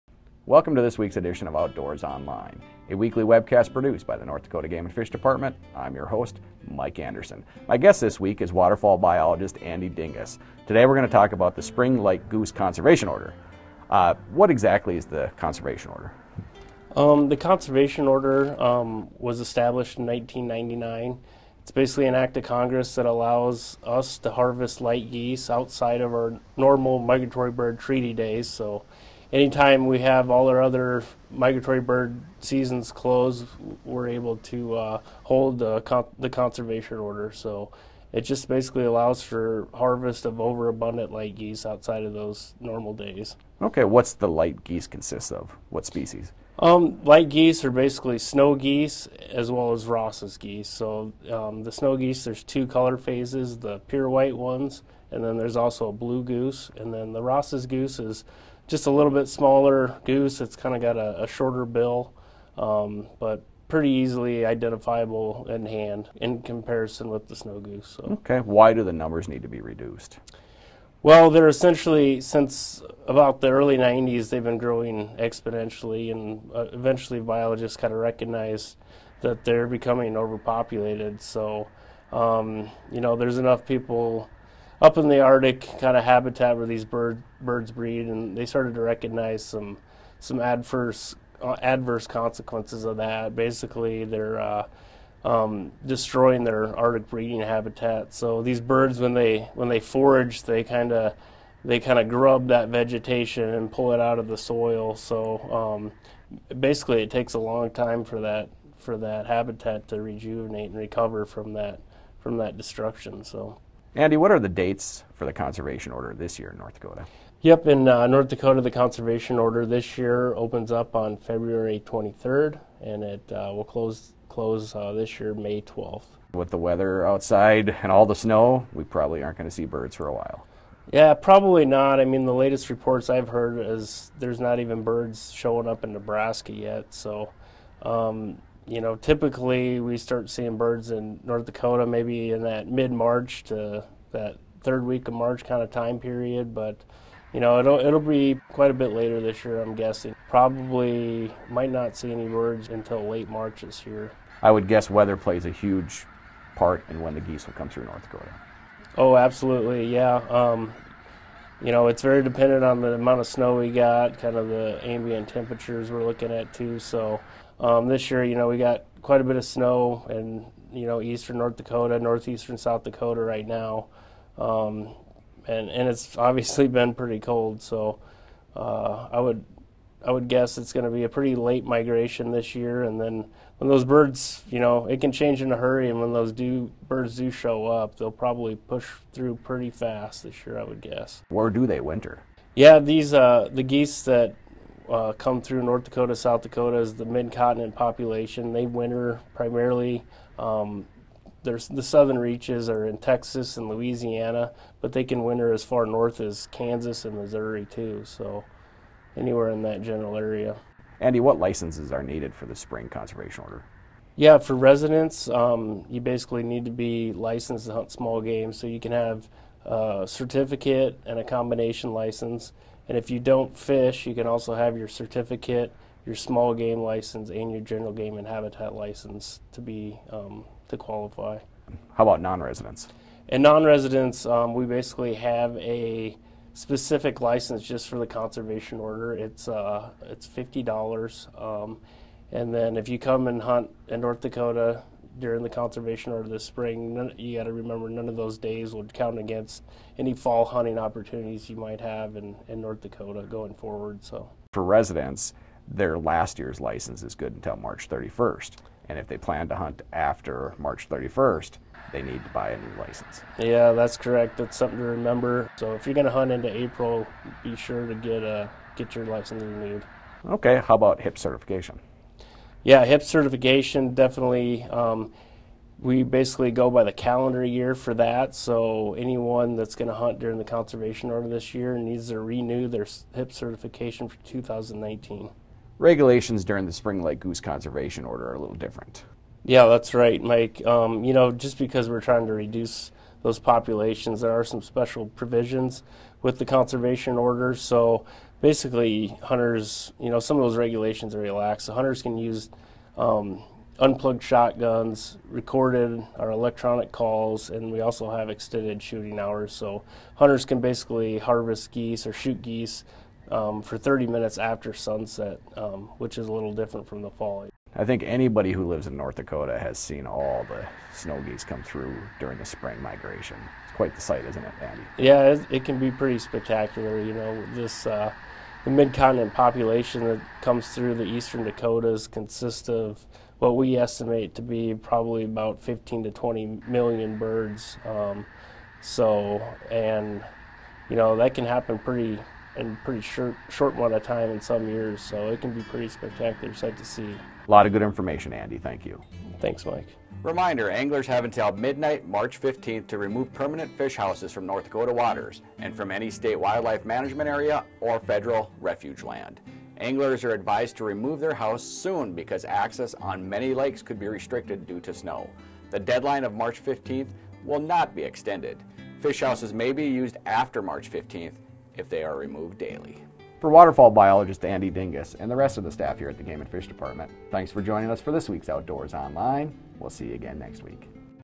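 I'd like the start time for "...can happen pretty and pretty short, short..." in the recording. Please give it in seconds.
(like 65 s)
341 s.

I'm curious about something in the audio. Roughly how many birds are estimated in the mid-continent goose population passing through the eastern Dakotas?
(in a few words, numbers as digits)
15 to 20 million.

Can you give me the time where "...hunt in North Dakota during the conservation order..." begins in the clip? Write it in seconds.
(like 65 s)
243 s.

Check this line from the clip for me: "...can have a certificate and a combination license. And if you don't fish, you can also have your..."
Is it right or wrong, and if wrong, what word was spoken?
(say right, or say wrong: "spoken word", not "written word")
right.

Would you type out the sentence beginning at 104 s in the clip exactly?
So um, basically, it takes a long time for that for that habitat to rejuvenate and recover from that from that destruction.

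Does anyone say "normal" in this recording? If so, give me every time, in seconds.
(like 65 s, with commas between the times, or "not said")
26 s, 42 s.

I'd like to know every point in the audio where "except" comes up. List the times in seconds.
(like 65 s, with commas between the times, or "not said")
not said.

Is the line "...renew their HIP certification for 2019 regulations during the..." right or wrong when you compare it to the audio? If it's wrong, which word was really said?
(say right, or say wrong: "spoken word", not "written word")
right.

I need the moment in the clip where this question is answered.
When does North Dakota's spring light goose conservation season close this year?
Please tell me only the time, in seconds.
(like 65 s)
125 s.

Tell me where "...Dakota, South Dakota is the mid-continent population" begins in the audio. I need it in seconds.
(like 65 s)
195 s.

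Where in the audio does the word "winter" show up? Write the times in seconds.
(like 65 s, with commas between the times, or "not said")
191 s, 198 s, 205 s.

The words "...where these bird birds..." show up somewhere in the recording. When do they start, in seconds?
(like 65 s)
86 s.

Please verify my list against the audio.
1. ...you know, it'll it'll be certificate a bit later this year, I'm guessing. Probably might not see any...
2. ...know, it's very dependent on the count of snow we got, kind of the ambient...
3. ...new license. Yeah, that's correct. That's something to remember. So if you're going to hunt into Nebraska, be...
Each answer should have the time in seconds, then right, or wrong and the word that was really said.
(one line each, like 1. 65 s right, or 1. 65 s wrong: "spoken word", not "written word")
1. 147 s wrong: "quite", not "certificate"
2. 161 s wrong: "amount", not "count"
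3. 262 s wrong: "April", not "Nebraska".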